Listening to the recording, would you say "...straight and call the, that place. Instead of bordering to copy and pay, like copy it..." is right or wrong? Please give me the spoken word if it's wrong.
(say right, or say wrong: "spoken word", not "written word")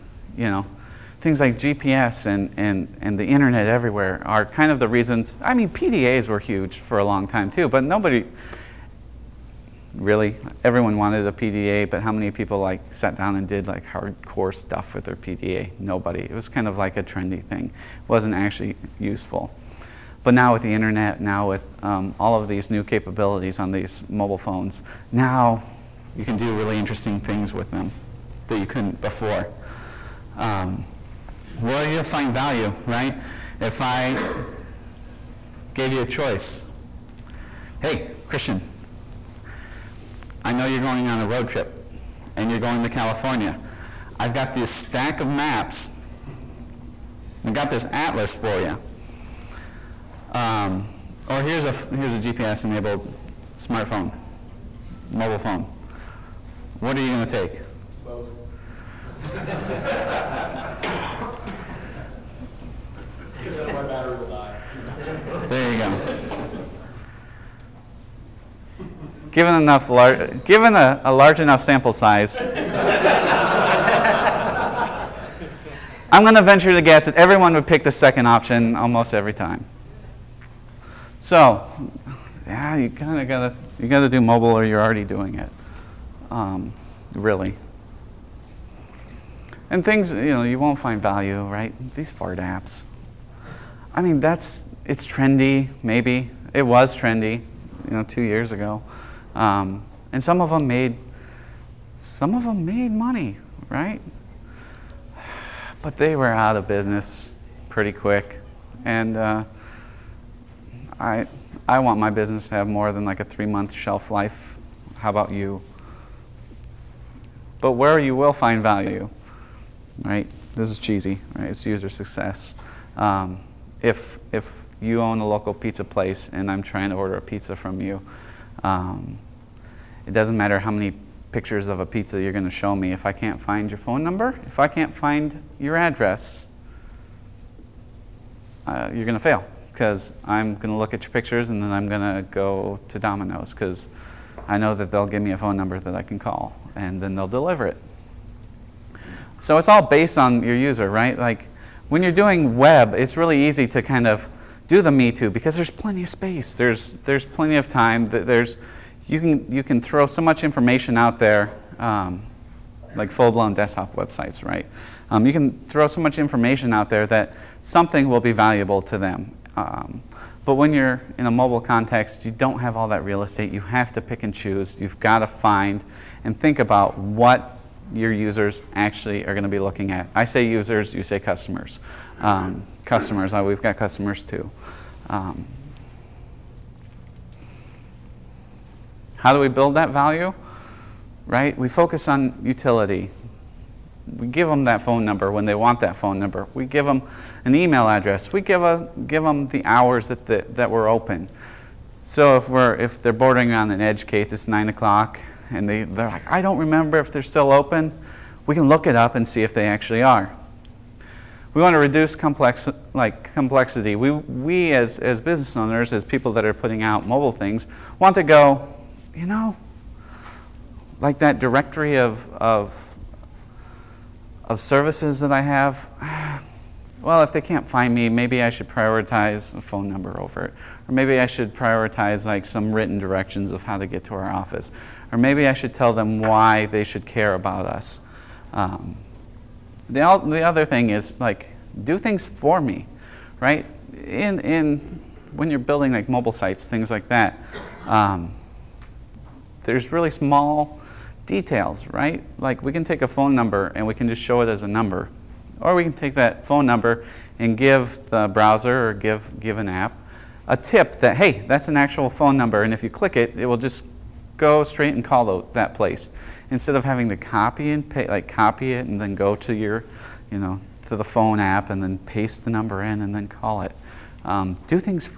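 wrong: "having", not "bordering".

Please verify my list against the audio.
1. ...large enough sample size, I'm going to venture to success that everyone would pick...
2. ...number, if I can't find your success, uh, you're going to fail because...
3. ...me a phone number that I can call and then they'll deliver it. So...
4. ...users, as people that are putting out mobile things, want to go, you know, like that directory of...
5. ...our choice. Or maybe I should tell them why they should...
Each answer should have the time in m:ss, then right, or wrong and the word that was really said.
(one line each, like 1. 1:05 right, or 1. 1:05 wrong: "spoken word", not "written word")
1. 1:11 wrong: "guess", not "success"
2. 2:14 wrong: "address", not "success"
3. 2:25 right
4. 3:35 wrong: "owners", not "users"
5. 3:54 wrong: "office", not "choice".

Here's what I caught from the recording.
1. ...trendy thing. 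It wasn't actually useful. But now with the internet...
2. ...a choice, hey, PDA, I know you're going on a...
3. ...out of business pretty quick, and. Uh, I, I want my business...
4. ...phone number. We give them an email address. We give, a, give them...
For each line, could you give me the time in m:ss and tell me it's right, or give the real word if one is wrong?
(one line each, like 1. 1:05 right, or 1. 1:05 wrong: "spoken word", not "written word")
1. 0:17 right
2. 0:36 wrong: "Christian", not "PDA"
3. 1:46 right
4. 3:15 right.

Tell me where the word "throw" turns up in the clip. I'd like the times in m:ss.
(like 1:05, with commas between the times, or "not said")
2:39, 2:45.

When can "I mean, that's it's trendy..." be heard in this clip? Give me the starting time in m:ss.
1:33.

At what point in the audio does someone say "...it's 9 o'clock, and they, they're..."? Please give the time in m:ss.
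3:24.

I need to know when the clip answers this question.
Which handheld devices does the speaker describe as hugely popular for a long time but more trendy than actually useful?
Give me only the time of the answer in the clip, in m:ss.
0:05.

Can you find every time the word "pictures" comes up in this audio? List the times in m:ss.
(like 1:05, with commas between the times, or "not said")
2:11, 2:21.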